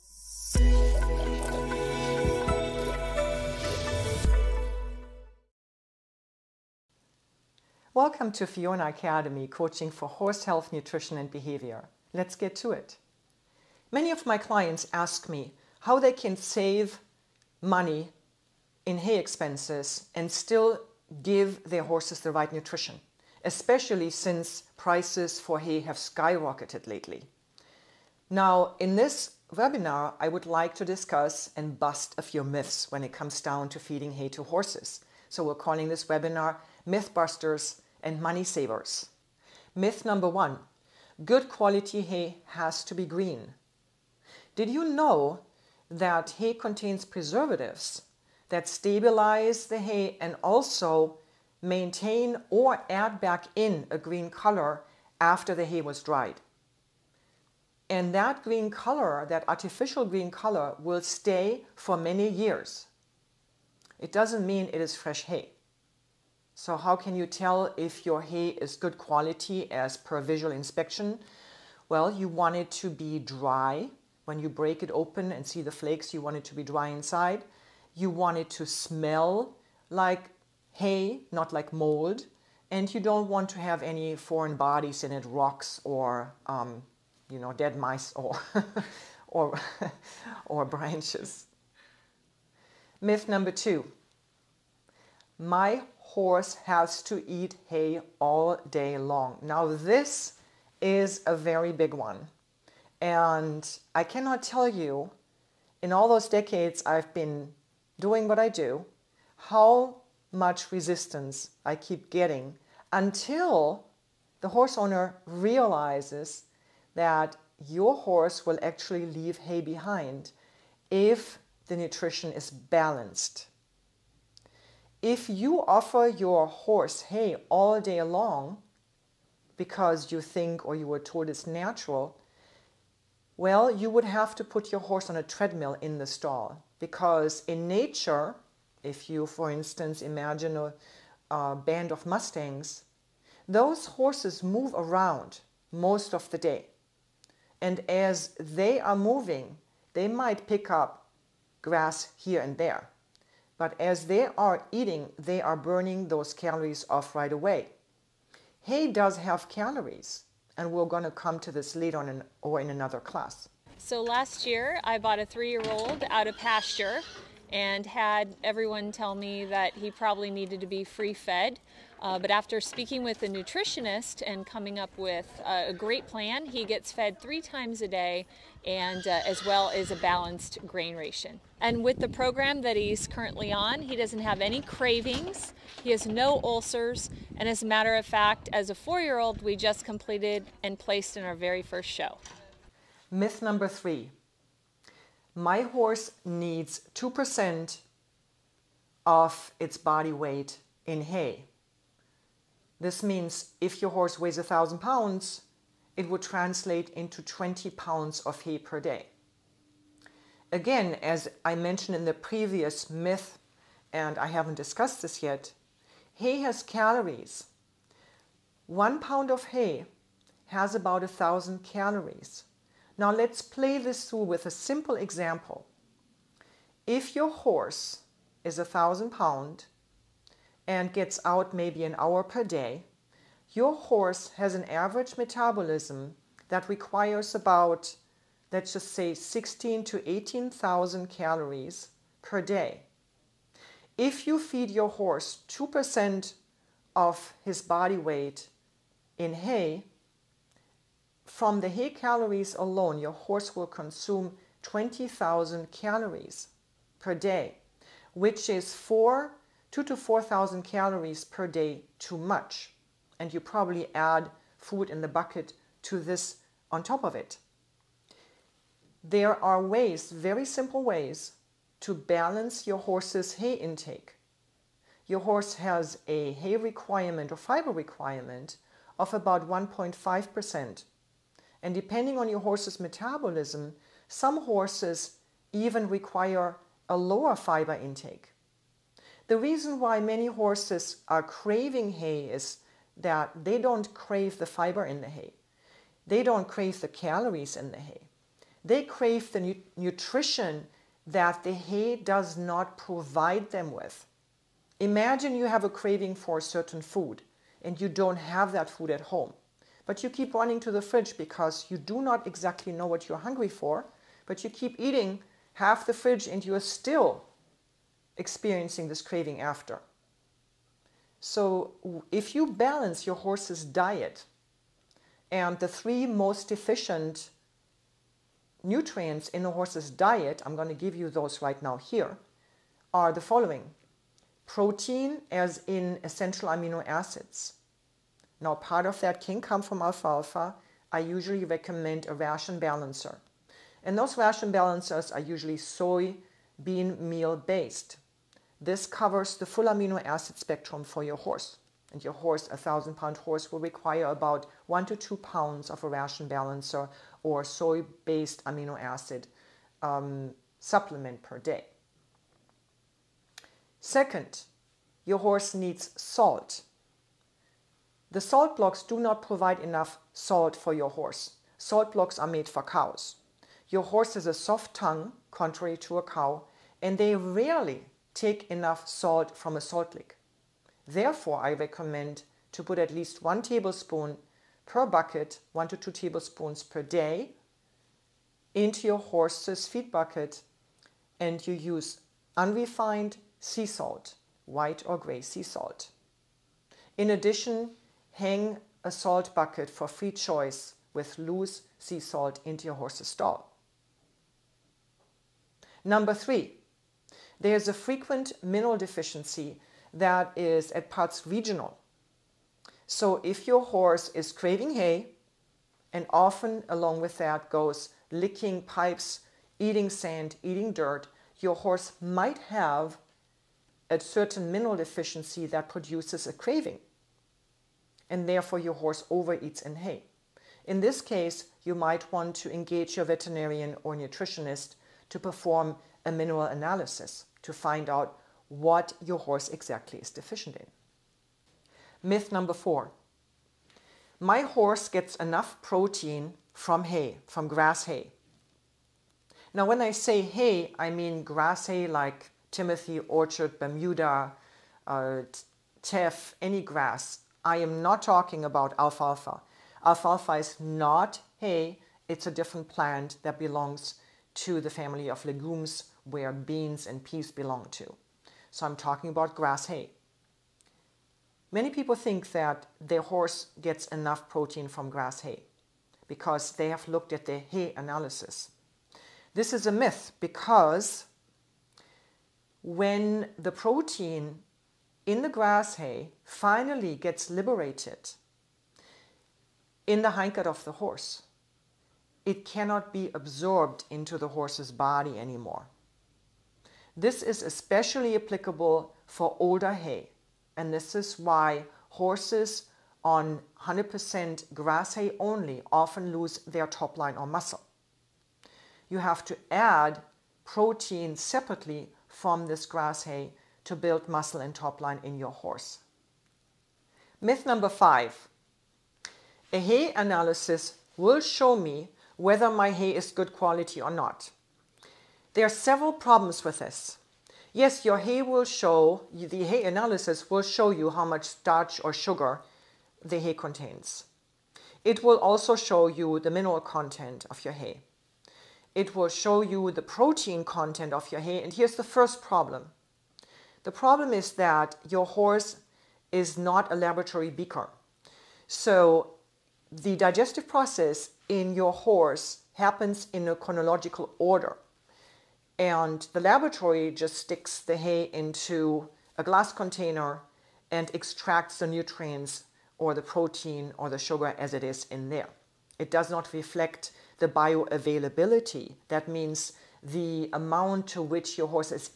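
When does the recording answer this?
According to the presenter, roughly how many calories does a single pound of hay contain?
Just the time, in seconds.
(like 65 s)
220 s.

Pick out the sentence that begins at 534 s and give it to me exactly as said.
It will also show you the mineral content of your hay.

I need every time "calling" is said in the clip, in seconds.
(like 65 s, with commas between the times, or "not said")
35 s.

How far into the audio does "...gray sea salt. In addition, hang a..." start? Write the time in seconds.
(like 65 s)
394 s.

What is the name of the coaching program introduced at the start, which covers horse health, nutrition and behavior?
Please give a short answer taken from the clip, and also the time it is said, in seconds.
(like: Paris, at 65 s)
Fiona Academy, at 8 s.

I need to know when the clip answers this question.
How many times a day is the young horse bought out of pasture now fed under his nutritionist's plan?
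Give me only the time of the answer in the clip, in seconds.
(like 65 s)
177 s.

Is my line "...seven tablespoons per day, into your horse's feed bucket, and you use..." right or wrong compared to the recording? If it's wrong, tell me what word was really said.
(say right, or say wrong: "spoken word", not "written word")
wrong: "two", not "seven".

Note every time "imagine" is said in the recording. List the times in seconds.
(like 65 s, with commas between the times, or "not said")
139 s, 304 s.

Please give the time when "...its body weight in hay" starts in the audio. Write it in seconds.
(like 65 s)
199 s.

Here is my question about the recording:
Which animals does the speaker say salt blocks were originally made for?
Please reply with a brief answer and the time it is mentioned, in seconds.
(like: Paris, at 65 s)
Cows, at 372 s.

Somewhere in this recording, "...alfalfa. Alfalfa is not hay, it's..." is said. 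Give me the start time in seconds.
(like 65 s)
458 s.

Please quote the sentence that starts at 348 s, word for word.
This covers the full amino acid spectrum for your horse.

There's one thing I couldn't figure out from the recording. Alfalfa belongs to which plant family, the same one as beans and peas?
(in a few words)
Legumes.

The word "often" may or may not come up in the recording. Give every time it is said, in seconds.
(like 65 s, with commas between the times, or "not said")
416 s, 505 s.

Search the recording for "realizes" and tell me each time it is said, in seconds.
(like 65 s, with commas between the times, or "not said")
115 s.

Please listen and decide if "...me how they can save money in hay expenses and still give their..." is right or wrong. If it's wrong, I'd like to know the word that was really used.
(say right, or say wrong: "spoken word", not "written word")
right.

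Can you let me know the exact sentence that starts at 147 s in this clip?
And as they are moving, they might pick up grass here and there.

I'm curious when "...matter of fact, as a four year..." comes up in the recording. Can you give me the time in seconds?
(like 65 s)
187 s.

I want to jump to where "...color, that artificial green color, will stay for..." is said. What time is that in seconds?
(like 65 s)
58 s.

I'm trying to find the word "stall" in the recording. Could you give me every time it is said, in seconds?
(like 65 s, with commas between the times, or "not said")
136 s, 403 s.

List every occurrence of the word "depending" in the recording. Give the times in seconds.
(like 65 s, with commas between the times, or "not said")
281 s.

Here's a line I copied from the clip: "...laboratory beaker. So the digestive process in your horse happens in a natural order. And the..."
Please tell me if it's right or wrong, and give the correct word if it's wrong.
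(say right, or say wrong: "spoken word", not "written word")
wrong: "chronological", not "natural".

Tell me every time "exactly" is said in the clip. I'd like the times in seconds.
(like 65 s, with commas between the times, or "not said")
312 s, 439 s.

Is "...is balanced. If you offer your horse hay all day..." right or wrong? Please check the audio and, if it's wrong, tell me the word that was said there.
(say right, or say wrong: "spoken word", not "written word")
right.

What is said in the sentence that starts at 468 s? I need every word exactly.
So I'm talking about grass hay.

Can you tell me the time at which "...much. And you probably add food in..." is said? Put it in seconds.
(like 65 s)
262 s.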